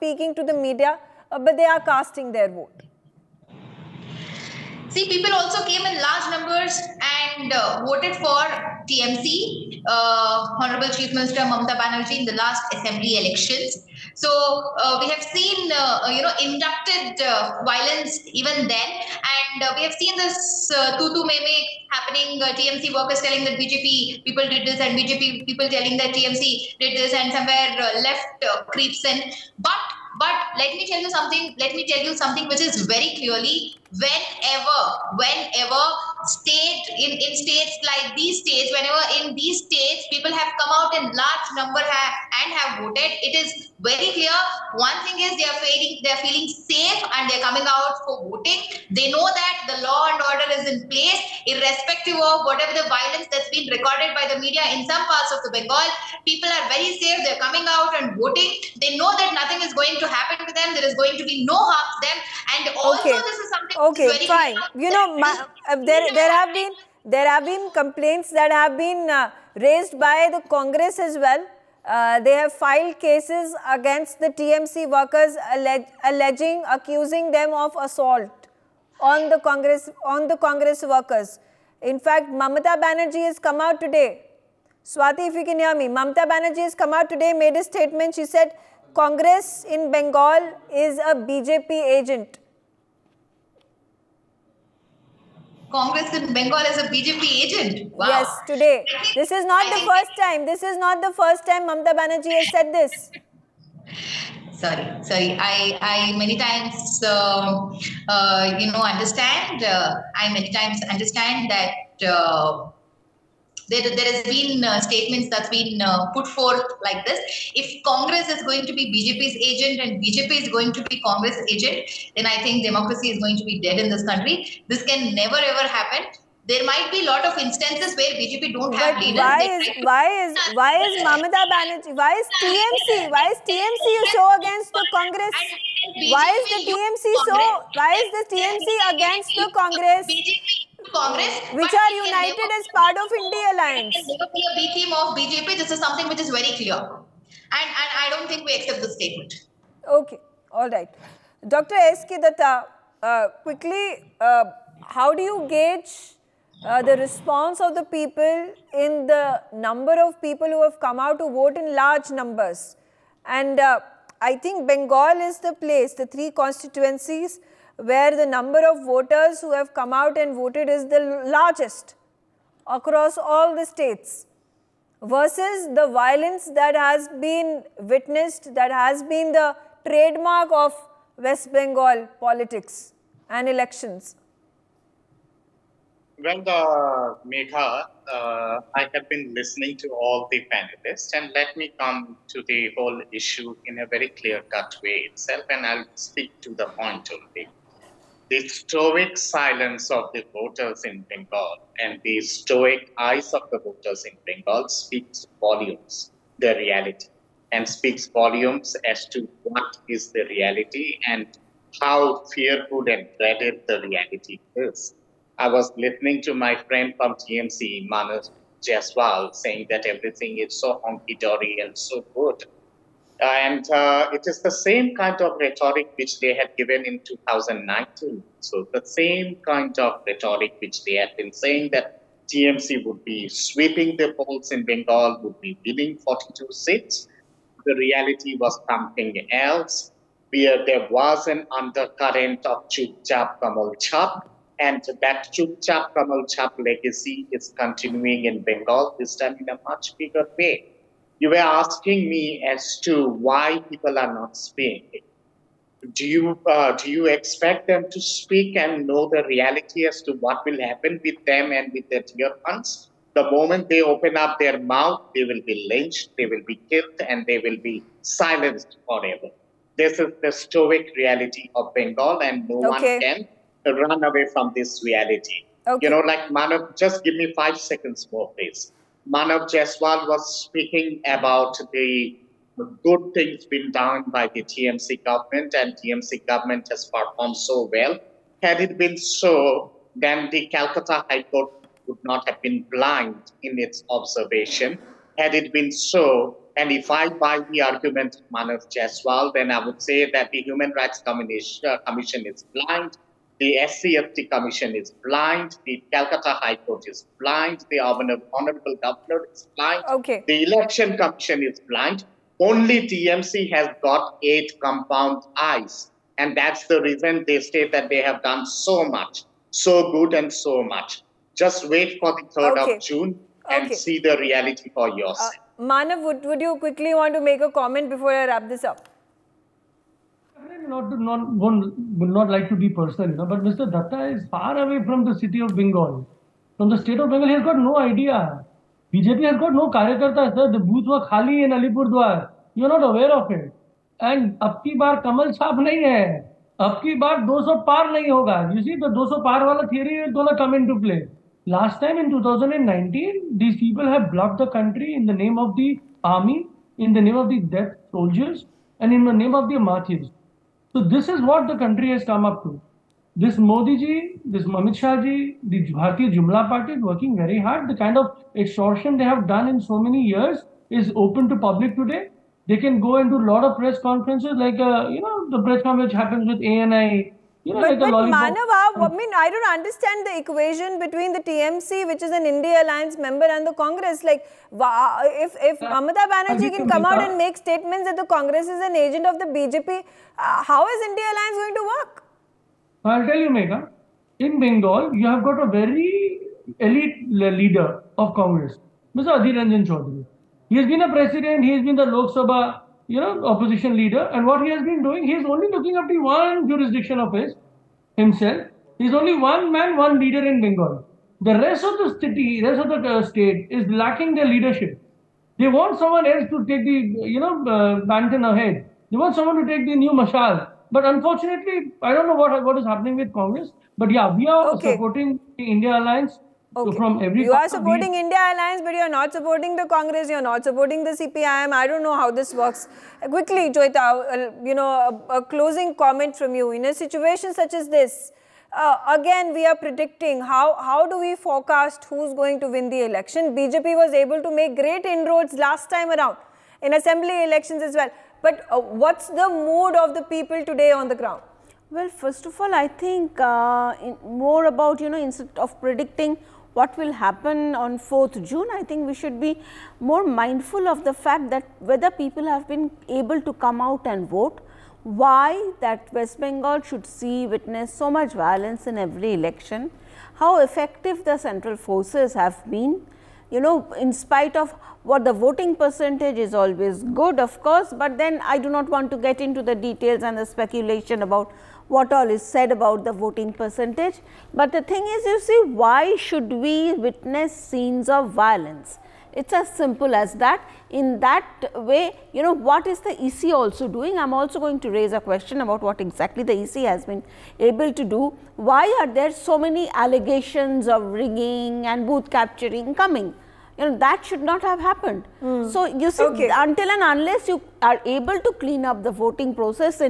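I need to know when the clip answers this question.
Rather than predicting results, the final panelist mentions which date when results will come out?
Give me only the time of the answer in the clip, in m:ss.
7:37.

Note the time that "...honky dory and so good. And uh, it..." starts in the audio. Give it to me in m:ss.
3:40.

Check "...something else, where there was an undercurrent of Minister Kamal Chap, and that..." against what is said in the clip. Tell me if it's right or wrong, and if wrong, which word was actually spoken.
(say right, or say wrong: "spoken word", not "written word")
wrong: "Chupchap", not "Minister".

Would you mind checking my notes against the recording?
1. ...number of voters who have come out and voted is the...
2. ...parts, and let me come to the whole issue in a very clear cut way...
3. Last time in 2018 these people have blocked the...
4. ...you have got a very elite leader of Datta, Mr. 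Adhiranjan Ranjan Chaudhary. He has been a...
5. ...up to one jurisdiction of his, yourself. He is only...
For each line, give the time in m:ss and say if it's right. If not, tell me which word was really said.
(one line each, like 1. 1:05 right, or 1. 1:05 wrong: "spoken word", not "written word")
1. 2:48 right
2. 3:10 wrong: "panelists", not "parts"
3. 5:51 wrong: "2019", not "2018"
4. 6:34 wrong: "Congress", not "Datta"
5. 6:45 wrong: "himself", not "yourself".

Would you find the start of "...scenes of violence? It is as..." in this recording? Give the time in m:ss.
8:07.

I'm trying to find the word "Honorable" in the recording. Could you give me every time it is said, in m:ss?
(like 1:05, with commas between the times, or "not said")
0:10, 5:07.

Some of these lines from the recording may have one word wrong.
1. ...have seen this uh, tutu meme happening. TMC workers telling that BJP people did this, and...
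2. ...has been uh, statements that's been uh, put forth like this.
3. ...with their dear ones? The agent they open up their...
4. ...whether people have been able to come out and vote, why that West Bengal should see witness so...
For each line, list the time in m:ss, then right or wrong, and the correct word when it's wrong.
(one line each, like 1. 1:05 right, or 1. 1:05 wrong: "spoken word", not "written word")
1. 0:19 right
2. 1:54 right
3. 4:21 wrong: "moment", not "agent"
4. 7:41 right.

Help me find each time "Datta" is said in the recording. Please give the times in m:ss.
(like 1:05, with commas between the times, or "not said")
2:32, 5:33.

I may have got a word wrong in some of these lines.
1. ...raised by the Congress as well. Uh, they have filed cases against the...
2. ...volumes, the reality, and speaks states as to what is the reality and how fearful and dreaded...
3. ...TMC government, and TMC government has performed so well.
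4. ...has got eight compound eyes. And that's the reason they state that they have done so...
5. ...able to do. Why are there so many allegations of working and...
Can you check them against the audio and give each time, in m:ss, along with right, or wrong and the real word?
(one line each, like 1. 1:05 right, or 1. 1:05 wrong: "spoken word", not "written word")
1. 1:09 right
2. 3:25 wrong: "volumes", not "states"
3. 4:44 right
4. 5:13 right
5. 8:17 wrong: "rigging", not "working".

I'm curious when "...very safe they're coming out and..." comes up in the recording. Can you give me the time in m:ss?
0:56.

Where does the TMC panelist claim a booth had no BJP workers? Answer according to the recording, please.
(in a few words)
Alipurdwar.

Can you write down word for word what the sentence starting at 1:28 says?
She said, Congress in Bengal is a BJP agent.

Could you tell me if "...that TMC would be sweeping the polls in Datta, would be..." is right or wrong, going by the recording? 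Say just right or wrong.
wrong.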